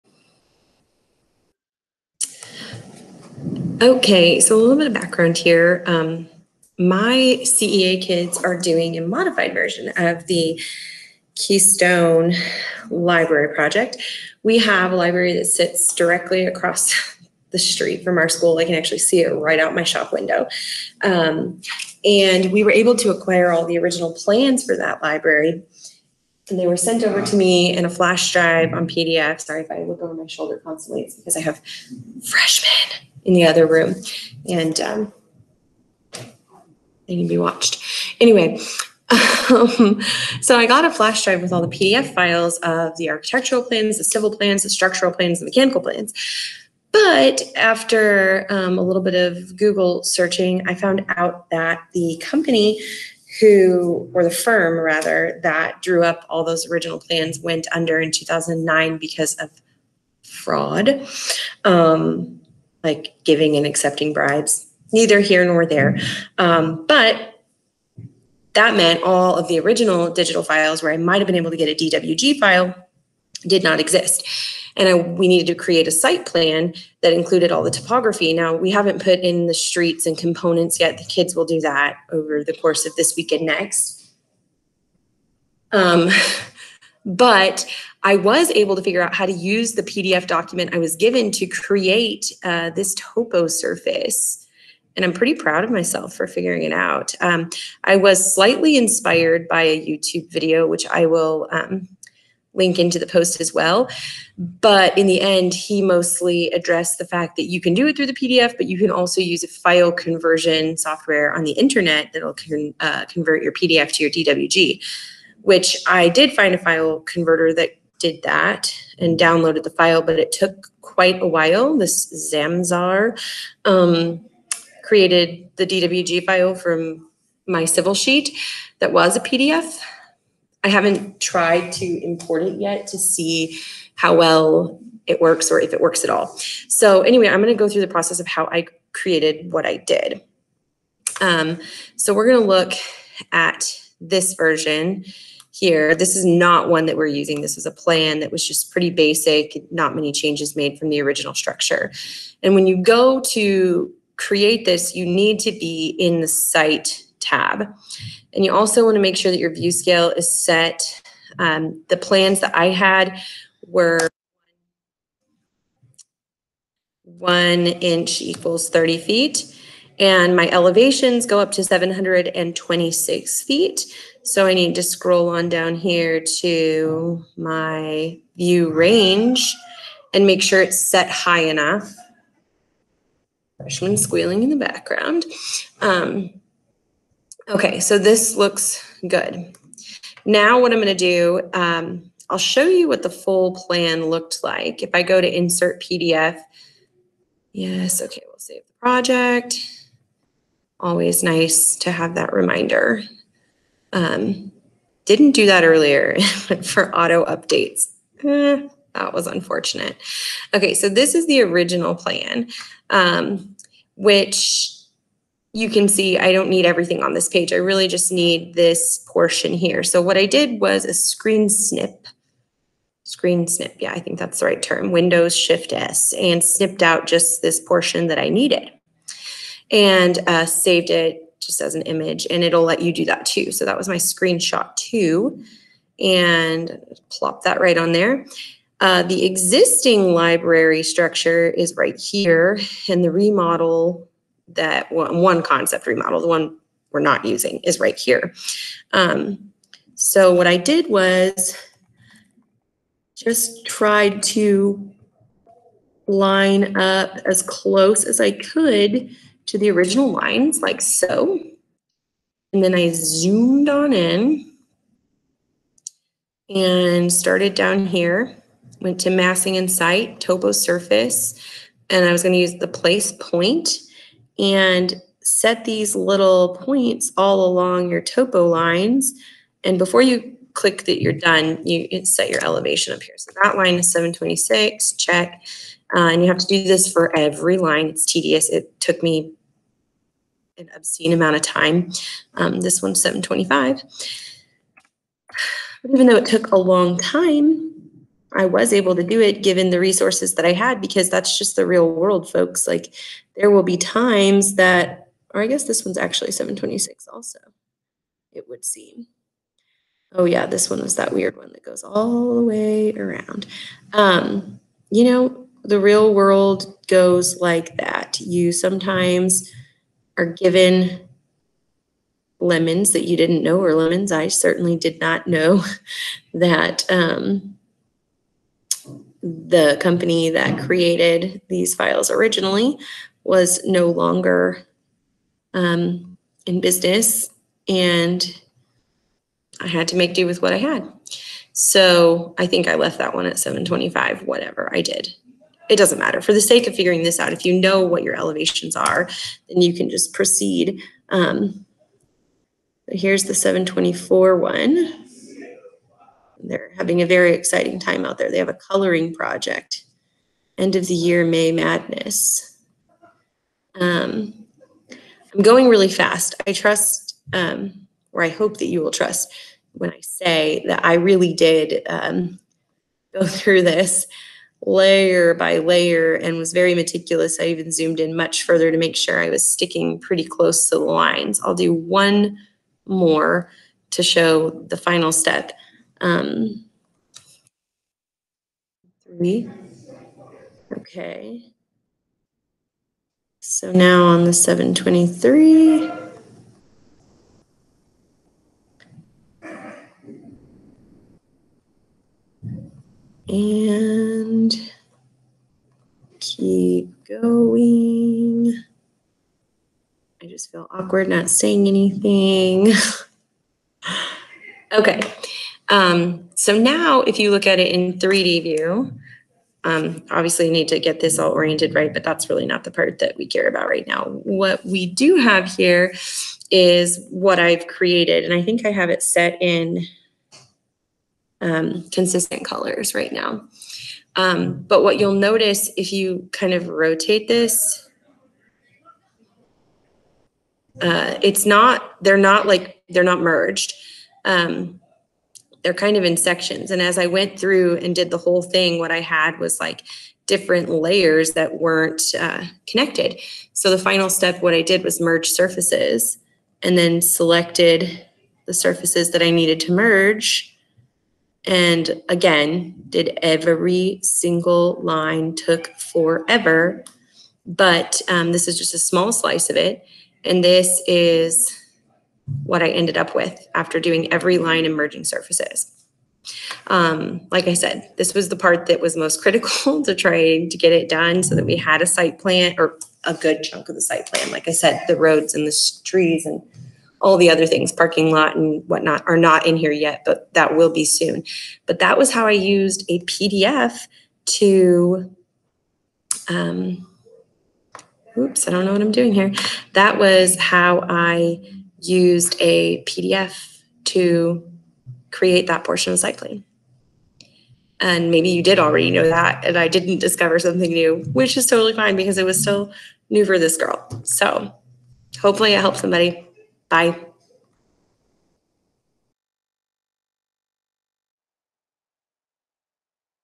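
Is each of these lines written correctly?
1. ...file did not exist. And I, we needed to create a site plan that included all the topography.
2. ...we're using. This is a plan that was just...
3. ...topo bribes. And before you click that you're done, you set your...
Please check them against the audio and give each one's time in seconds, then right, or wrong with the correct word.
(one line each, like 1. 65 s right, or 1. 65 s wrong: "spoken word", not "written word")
1. 72 s right
2. 146 s right
3. 278 s wrong: "lines", not "bribes".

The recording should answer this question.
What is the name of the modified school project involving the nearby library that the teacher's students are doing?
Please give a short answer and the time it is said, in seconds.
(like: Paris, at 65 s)
Keystone Library Project, at 11 s.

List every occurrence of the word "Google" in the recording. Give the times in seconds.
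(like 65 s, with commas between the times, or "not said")
49 s.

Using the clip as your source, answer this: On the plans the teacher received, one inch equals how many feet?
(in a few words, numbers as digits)
30 feet.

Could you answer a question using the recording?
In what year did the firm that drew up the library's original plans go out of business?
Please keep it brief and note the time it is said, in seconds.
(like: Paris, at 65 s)
2009, at 58 s.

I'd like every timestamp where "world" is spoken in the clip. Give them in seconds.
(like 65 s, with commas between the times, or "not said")
301 s, 316 s.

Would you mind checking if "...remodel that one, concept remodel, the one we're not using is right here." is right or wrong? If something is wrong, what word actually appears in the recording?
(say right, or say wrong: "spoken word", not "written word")
right.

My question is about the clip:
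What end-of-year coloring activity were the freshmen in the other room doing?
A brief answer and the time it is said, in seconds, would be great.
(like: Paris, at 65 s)
May Madness, at 361 s.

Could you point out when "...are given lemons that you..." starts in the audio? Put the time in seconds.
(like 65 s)
320 s.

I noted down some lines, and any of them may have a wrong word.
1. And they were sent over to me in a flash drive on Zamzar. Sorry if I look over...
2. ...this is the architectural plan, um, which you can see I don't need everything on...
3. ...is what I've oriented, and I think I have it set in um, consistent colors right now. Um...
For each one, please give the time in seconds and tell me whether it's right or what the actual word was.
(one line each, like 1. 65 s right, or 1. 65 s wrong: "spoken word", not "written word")
1. 26 s wrong: "PDF", not "Zamzar"
2. 210 s wrong: "original", not "architectural"
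3. 426 s wrong: "created", not "oriented".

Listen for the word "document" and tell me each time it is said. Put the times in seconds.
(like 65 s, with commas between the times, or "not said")
90 s.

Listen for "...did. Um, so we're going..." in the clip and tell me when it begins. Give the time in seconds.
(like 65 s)
139 s.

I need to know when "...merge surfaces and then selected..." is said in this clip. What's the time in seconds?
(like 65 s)
455 s.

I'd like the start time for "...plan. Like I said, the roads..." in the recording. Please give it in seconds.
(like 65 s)
484 s.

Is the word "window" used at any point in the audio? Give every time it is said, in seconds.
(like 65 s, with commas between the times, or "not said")
20 s, 224 s.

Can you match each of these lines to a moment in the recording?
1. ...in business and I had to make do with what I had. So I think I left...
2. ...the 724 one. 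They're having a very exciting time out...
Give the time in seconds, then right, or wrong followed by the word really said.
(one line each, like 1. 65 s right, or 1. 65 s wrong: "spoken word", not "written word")
1. 336 s right
2. 353 s right.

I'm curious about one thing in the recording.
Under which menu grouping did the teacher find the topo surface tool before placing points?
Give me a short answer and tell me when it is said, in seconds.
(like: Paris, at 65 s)
massing in site, at 269 s.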